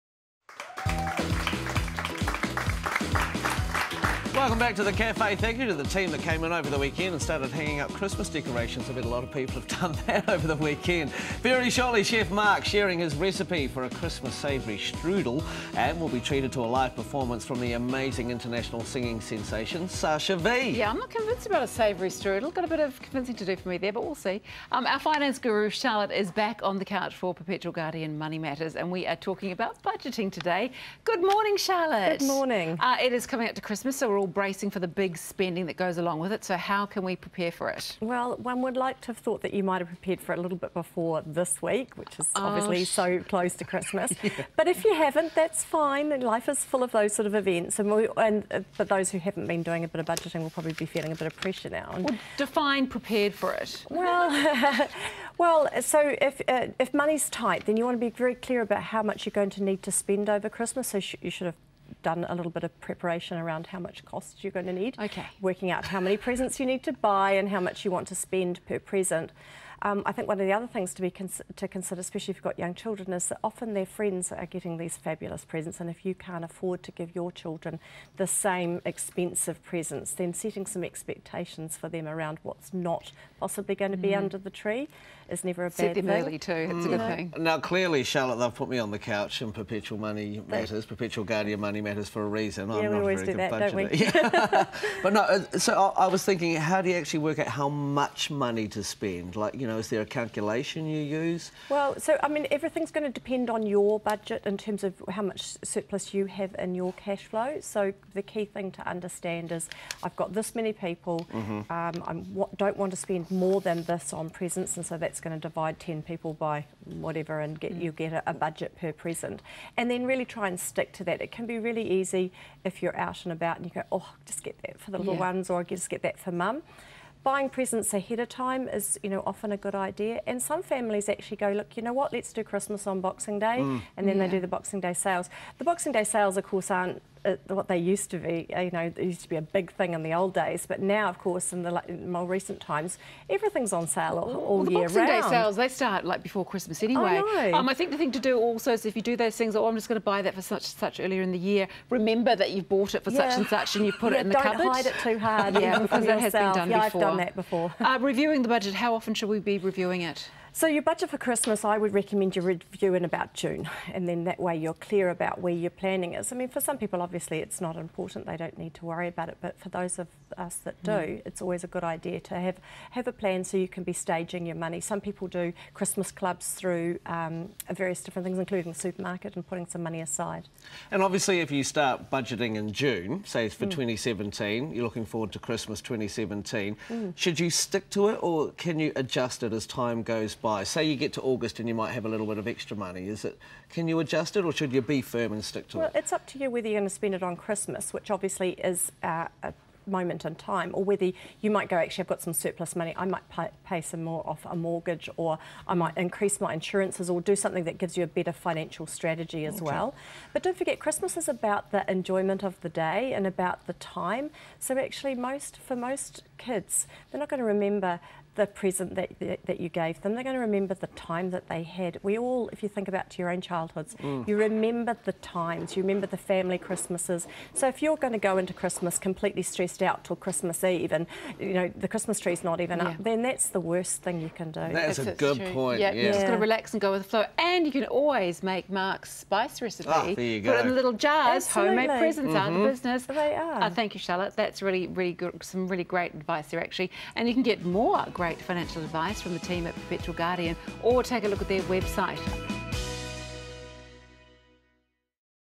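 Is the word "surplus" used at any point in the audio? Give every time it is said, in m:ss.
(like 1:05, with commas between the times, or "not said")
1:45, 3:22.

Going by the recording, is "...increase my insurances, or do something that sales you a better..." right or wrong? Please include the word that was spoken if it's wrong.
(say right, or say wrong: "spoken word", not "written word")
wrong: "gives", not "sales".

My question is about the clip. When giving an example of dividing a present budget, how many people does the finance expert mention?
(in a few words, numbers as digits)
10.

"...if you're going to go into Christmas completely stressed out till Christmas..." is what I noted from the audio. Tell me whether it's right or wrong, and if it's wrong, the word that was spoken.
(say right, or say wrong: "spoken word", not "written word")
right.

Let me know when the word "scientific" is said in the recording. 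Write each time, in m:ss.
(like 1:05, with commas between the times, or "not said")
not said.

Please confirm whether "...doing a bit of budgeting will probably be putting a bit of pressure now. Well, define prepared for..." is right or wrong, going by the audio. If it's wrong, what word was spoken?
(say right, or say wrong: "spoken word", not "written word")
wrong: "feeling", not "putting".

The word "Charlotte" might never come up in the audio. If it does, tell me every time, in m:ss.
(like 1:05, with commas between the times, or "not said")
0:25, 0:31, 1:28, 4:04.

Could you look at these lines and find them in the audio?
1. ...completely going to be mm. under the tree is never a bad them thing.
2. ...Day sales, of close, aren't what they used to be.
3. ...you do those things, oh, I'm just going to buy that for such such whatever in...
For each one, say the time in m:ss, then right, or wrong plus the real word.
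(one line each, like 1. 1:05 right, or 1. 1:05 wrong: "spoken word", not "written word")
1. 1:23 wrong: "possibly", not "completely"
2. 2:15 wrong: "course", not "close"
3. 2:28 wrong: "earlier", not "whatever".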